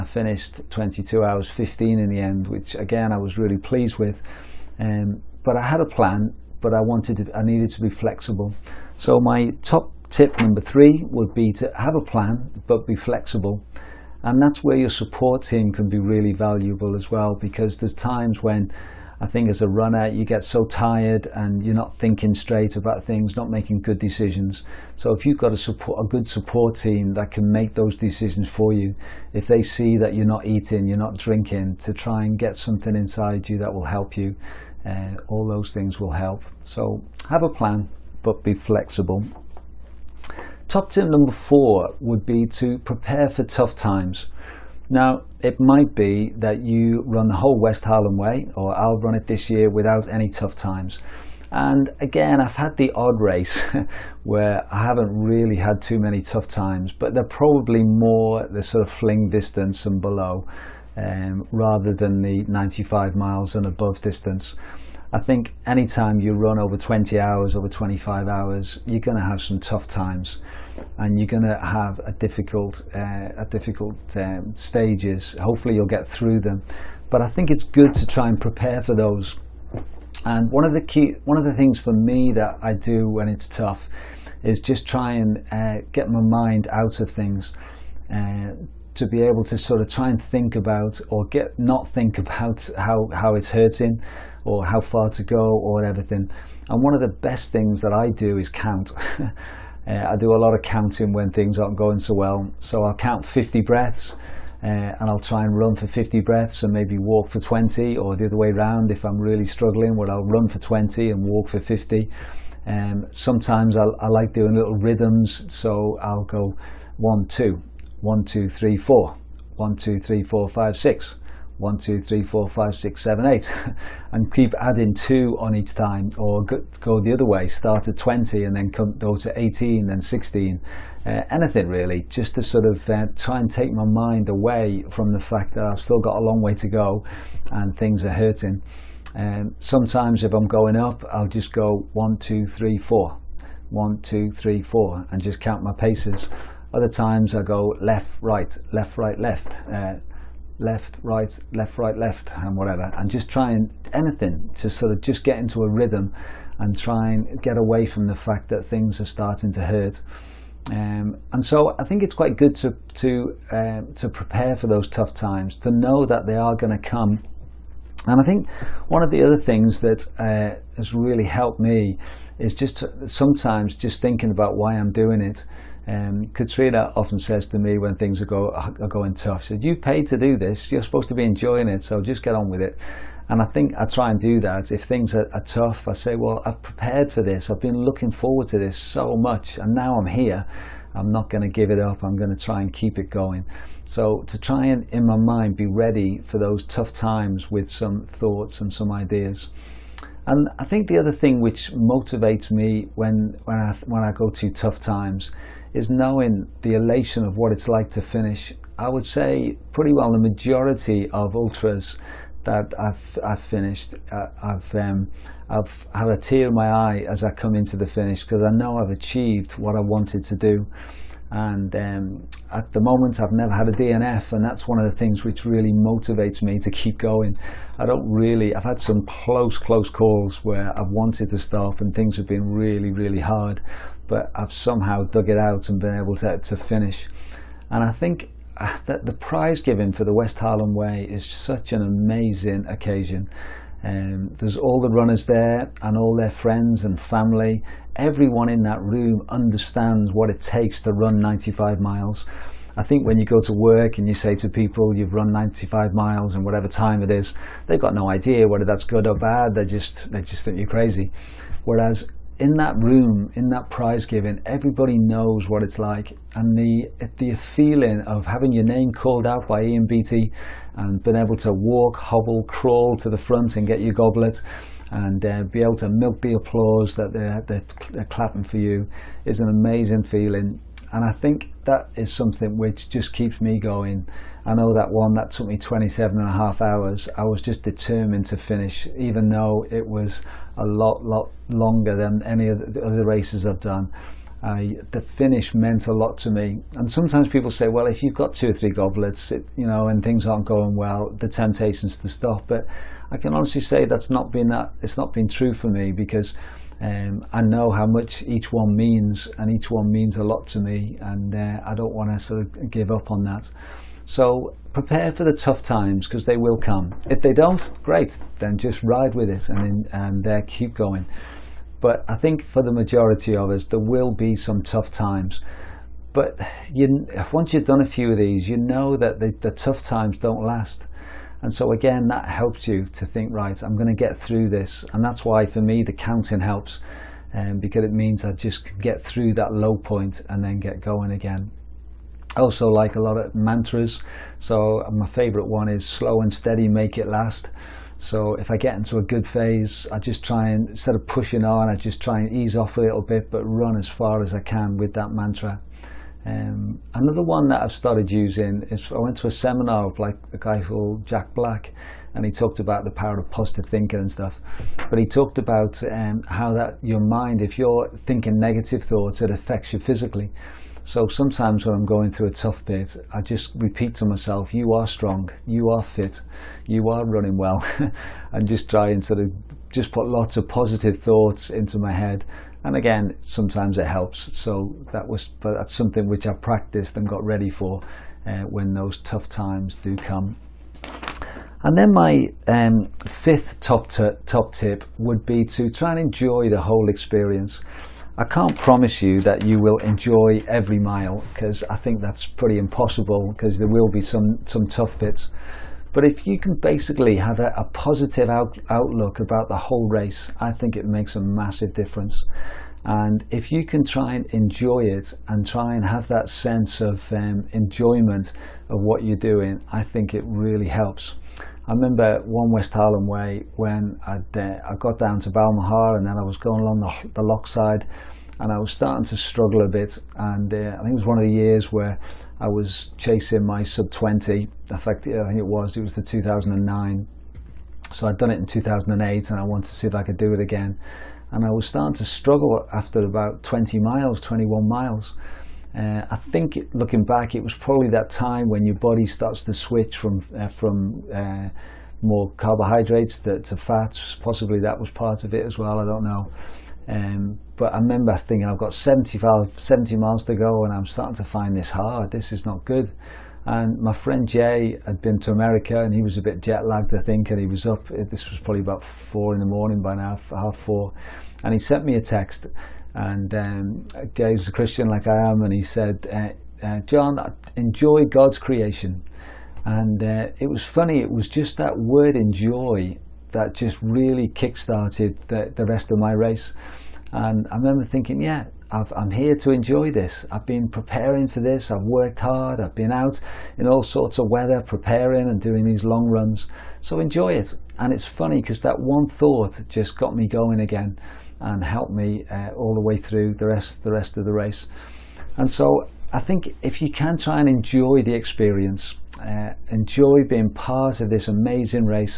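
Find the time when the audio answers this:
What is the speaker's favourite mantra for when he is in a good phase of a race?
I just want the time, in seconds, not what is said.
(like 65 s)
345 s.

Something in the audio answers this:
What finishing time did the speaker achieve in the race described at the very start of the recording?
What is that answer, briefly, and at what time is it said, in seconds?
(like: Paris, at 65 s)
22 hours 15, at 0 s.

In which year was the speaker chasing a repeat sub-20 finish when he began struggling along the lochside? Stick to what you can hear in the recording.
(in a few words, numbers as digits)
2009.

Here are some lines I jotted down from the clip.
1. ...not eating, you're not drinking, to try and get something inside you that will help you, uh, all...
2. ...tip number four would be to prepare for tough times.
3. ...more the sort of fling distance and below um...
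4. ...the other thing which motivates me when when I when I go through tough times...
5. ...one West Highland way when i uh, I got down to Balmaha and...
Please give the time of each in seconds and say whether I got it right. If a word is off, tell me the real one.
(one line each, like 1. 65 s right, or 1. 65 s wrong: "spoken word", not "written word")
1. 30 s right
2. 40 s right
3. 57 s right
4. 200 s right
5. 422 s right.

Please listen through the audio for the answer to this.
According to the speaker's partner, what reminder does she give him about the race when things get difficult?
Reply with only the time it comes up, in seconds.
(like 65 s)
179 s.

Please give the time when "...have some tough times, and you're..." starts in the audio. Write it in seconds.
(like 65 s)
69 s.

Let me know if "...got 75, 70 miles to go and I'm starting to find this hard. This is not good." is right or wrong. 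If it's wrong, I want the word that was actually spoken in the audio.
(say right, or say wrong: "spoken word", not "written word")
right.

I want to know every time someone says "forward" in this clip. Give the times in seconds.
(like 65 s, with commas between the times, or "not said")
188 s.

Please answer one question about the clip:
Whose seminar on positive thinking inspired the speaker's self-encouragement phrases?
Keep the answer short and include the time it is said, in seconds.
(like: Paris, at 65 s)
Jack Black, at 361 s.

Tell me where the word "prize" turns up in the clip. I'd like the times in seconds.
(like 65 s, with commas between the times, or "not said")
239 s, 263 s.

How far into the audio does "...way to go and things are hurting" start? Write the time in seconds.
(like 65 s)
136 s.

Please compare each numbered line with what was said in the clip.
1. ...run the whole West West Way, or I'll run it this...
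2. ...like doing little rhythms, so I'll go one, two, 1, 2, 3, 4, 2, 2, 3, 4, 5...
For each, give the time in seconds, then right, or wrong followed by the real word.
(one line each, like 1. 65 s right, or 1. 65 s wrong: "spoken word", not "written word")
1. 47 s wrong: "Highland", not "West"
2. 114 s wrong: "1", not "2".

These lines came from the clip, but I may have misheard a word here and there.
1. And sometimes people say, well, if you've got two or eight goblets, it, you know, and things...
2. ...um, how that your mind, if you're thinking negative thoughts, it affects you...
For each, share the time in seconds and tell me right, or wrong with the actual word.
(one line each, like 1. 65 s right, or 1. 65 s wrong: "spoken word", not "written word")
1. 296 s wrong: "three", not "eight"
2. 365 s right.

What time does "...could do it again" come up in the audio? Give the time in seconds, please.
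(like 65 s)
440 s.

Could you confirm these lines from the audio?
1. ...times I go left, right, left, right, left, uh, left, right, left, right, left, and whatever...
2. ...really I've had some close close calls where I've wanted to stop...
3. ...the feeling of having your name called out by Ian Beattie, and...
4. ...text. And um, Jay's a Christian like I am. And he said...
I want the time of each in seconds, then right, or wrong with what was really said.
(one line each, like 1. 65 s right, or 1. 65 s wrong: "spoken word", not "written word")
1. 146 s right
2. 228 s right
3. 267 s right
4. 472 s right.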